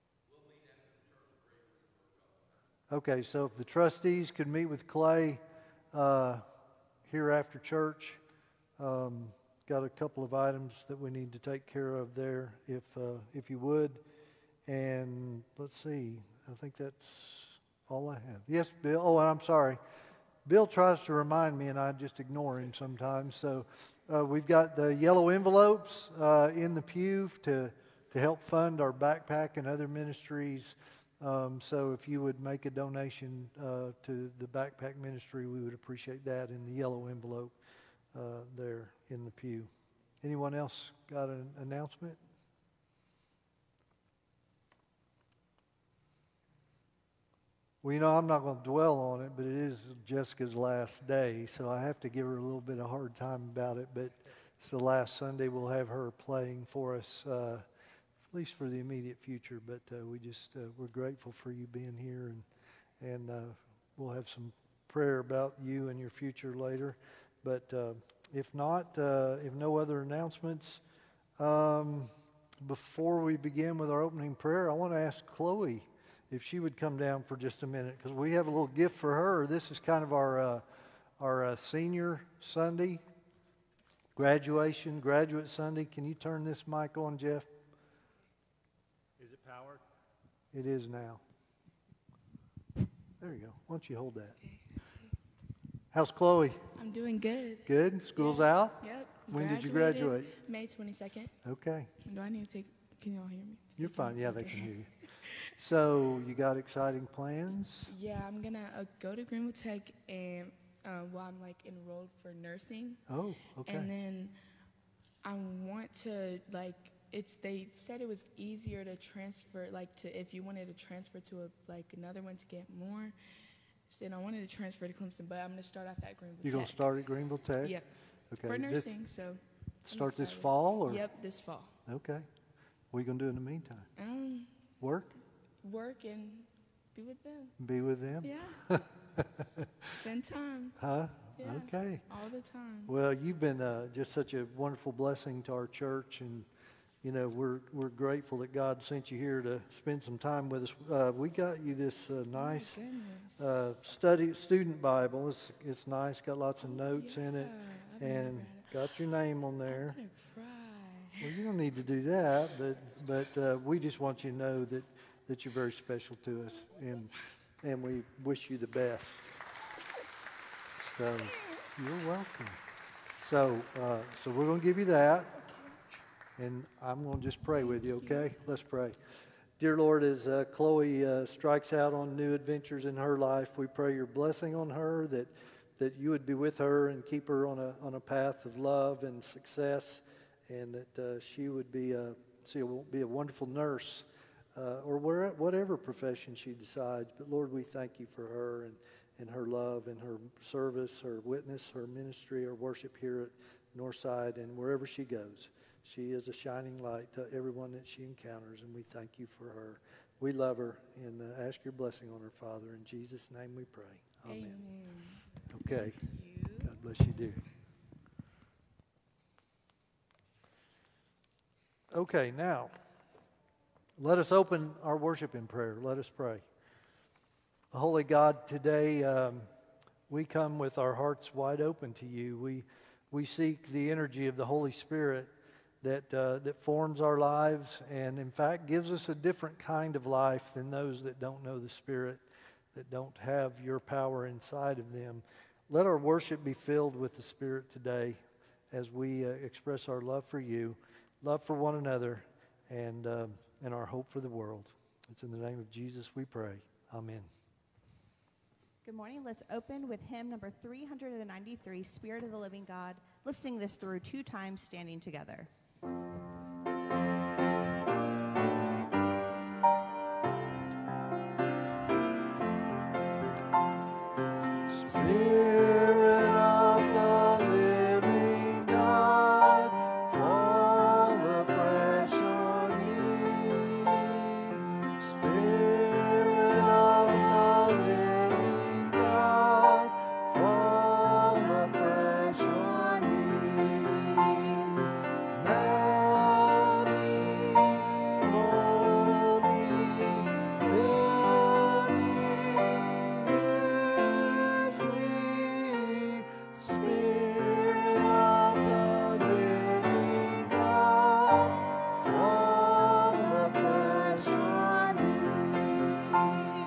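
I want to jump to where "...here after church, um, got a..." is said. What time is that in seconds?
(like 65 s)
7 s.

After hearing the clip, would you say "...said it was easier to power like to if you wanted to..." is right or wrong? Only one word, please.
wrong.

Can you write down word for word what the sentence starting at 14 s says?
And let's see, I think that's all I have.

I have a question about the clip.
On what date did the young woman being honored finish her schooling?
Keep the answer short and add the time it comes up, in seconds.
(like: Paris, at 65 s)
May 22nd, at 100 s.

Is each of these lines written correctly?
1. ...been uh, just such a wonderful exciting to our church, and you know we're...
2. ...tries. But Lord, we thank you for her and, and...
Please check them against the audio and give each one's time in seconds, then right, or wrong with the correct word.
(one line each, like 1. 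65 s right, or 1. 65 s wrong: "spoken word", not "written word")
1. 143 s wrong: "blessing", not "exciting"
2. 196 s wrong: "decides", not "tries".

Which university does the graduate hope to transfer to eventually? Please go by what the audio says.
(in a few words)
Clemson.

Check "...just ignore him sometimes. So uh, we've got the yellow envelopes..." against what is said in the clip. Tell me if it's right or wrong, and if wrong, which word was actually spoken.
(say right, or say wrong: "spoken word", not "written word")
right.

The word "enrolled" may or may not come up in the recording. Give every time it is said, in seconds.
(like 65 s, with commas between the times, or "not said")
111 s.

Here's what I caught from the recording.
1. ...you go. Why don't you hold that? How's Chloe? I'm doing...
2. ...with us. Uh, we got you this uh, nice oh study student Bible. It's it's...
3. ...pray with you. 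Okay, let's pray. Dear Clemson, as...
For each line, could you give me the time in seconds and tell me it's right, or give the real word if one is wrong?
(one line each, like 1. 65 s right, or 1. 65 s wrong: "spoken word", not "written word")
1. 93 s right
2. 150 s right
3. 177 s wrong: "Lord", not "Clemson".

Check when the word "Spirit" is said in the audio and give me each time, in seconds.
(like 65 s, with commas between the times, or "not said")
234 s, 241 s, 247 s, 261 s.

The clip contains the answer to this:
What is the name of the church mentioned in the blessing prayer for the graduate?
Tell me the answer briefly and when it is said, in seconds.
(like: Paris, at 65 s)
Northside, at 203 s.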